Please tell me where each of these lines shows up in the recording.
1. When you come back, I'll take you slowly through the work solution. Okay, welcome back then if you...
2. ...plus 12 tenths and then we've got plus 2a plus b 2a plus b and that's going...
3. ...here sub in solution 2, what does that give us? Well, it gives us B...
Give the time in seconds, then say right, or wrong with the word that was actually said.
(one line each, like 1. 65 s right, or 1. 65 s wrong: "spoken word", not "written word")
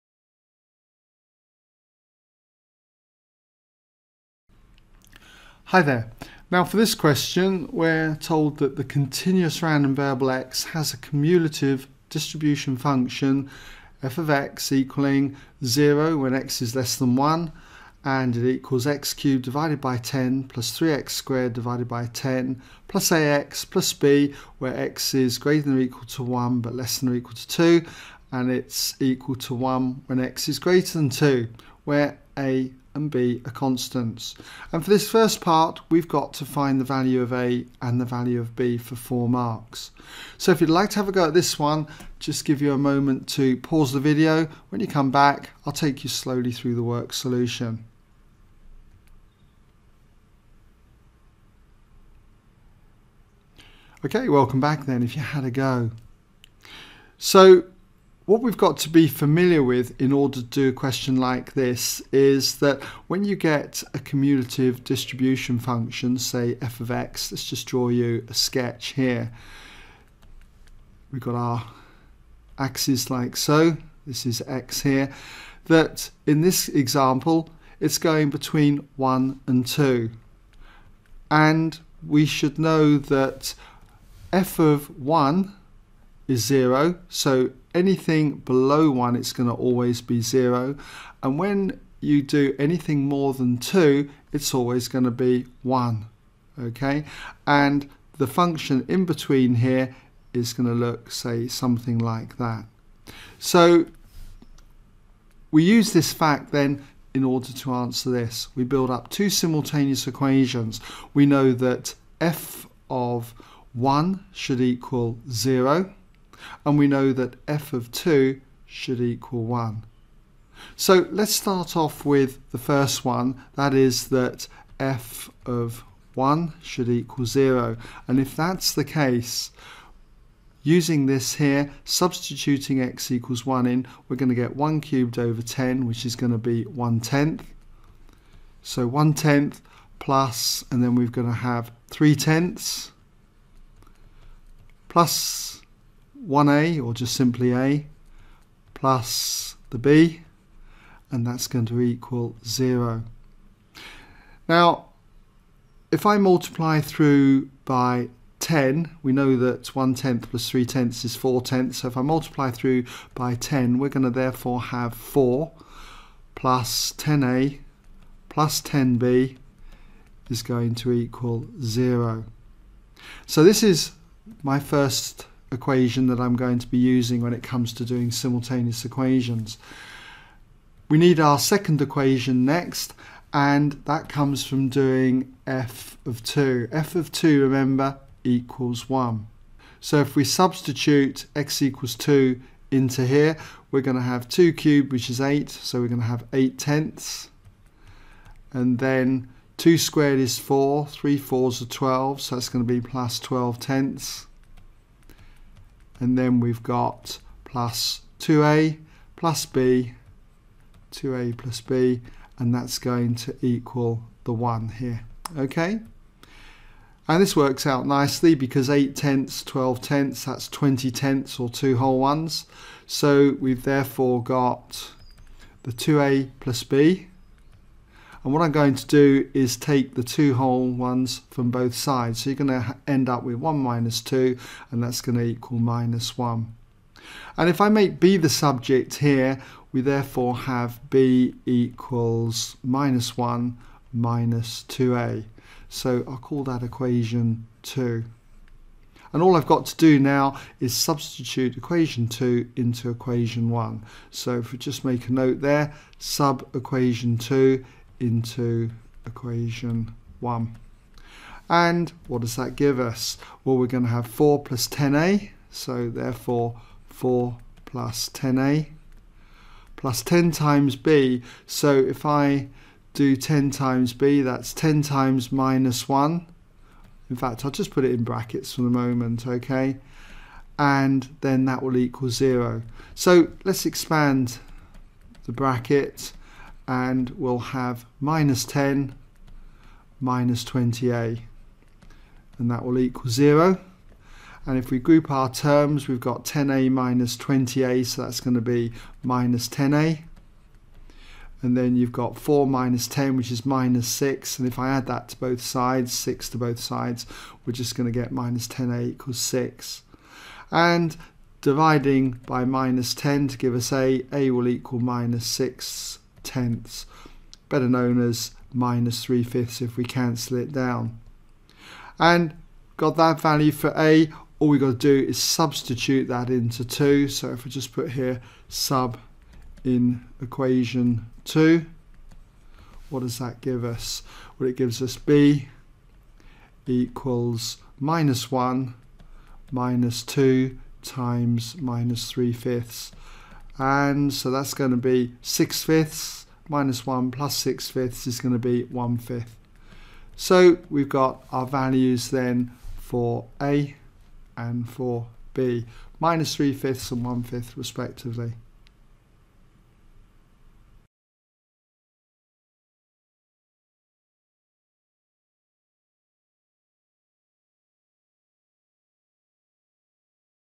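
1. 44 s right
2. 202 s right
3. 327 s wrong: "equation", not "solution".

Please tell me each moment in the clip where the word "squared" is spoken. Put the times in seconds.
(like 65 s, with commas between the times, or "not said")
21 s, 199 s.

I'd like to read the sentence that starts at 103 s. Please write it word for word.
So we use this fact then in order to answer this.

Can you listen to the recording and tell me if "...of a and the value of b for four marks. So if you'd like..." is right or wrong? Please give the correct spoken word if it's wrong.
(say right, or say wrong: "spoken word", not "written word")
right.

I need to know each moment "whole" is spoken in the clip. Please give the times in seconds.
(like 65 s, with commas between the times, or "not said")
221 s, 230 s.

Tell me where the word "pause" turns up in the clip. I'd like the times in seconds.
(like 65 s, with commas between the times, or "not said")
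43 s.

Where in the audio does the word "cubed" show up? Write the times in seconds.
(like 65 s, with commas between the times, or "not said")
19 s, 134 s, 194 s.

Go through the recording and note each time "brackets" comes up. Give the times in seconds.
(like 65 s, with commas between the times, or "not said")
278 s, 285 s.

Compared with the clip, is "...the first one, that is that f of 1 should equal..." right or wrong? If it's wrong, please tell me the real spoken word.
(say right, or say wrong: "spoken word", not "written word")
right.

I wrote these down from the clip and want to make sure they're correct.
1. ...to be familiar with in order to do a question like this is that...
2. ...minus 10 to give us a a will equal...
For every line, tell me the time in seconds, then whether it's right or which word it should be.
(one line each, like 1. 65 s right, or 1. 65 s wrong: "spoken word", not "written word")
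1. 58 s right
2. 312 s right.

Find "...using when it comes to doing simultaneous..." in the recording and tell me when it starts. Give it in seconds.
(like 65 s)
176 s.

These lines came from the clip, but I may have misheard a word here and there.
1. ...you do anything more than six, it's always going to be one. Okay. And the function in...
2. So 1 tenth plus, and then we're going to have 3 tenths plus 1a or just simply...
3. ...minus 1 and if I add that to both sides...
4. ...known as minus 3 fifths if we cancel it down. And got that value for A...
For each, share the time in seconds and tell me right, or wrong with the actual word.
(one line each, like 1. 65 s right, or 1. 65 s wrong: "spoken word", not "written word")
1. 91 s wrong: "two", not "six"
2. 138 s right
3. 303 s wrong: "6", not "1"
4. 317 s right.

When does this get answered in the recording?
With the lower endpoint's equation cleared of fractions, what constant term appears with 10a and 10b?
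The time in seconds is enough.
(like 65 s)
164 s.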